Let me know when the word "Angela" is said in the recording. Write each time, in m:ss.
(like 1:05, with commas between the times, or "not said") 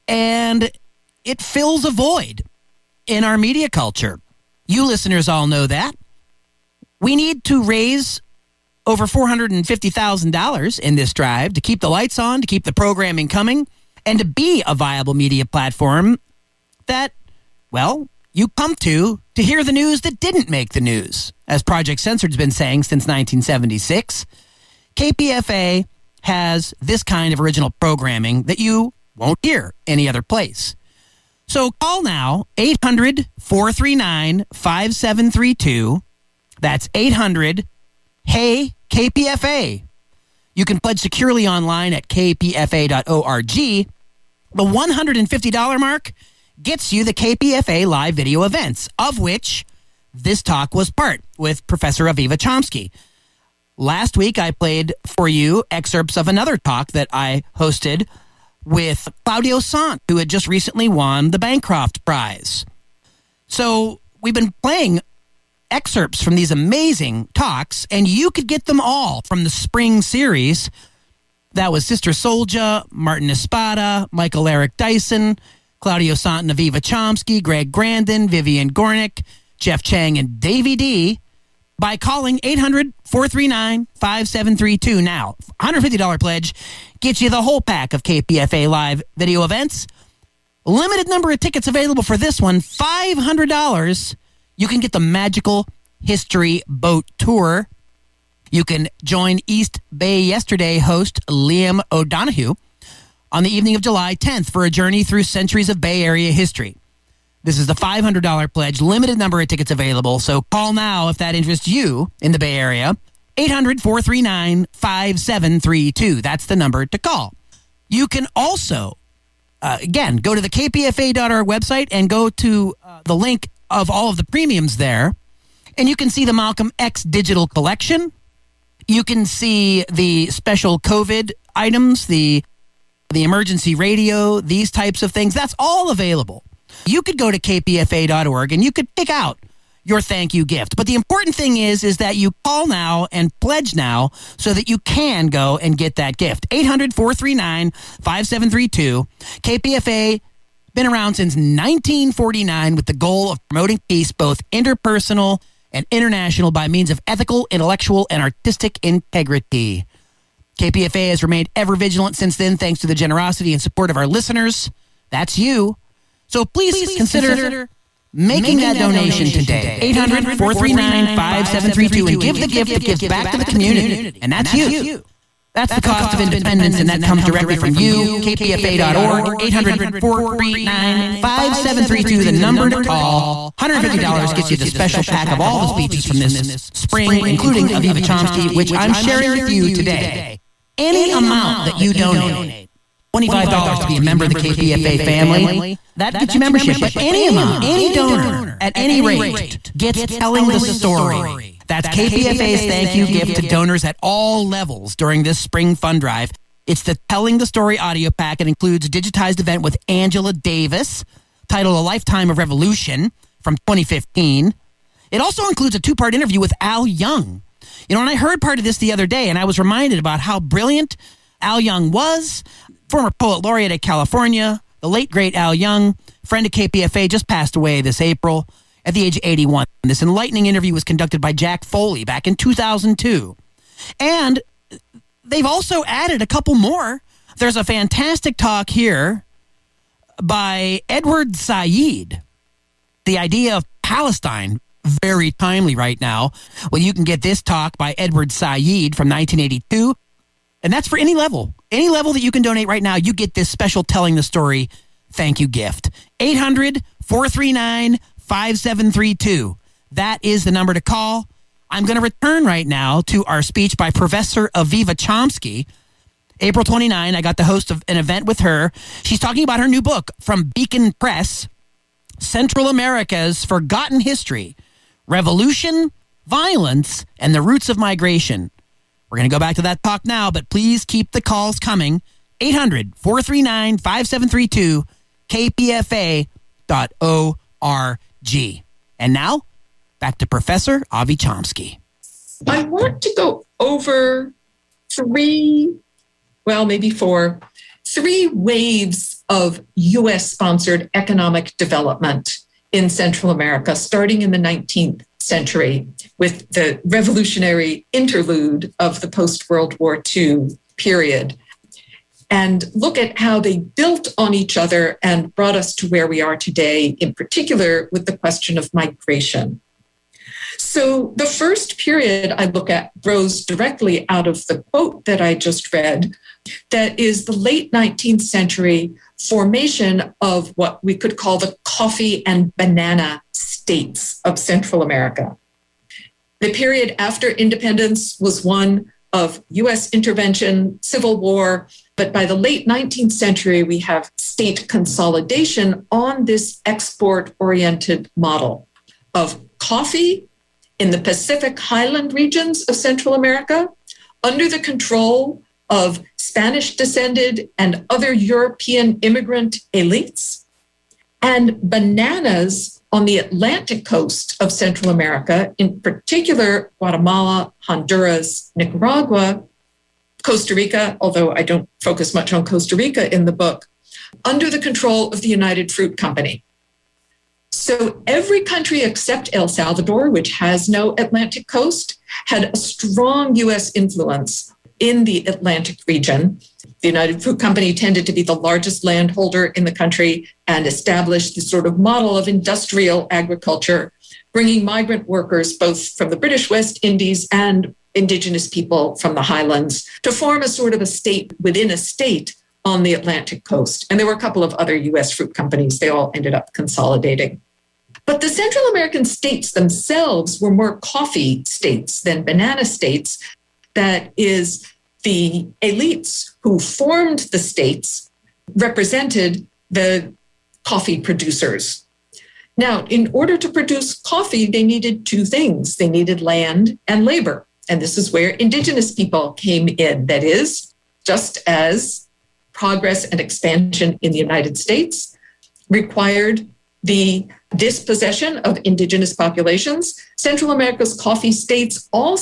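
3:29.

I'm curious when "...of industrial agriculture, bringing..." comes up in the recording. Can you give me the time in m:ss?
6:32.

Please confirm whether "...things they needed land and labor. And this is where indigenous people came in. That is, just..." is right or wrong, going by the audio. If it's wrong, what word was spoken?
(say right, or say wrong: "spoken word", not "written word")
right.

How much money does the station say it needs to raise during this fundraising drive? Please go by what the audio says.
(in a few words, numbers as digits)
$450,000.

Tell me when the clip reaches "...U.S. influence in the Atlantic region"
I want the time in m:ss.
6:23.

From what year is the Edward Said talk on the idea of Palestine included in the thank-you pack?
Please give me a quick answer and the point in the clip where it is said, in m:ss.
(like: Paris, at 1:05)
1982, at 4:09.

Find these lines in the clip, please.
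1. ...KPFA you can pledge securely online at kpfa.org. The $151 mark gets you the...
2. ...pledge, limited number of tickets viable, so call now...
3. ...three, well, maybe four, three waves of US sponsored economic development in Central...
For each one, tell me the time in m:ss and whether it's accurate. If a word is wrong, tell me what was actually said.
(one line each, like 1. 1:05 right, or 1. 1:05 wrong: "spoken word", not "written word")
1. 0:38 wrong: "150", not "151"
2. 1:48 wrong: "available", not "viable"
3. 4:54 right.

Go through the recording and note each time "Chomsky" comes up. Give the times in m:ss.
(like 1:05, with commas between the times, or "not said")
0:52, 1:16, 3:08, 4:24, 4:51.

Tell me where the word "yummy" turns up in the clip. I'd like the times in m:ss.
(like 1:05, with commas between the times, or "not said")
not said.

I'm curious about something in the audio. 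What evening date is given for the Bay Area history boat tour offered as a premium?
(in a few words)
July 10th.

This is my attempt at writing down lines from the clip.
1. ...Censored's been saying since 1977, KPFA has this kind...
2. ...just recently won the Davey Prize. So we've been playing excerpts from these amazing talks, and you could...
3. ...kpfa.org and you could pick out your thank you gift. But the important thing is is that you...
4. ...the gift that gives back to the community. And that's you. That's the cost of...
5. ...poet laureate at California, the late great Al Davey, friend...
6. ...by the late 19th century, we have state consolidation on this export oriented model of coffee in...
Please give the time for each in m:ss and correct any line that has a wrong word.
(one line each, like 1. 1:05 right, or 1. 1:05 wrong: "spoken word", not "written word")
1. 0:22 wrong: "1976", not "1977"
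2. 1:00 wrong: "Bancroft", not "Davey"
3. 2:17 right
4. 2:52 right
5. 3:43 wrong: "Young", not "Davey"
6. 5:42 right.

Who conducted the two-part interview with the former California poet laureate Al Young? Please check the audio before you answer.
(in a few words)
Jack Foley.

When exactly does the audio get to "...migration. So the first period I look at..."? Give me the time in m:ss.
5:18.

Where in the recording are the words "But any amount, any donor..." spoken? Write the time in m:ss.
3:16.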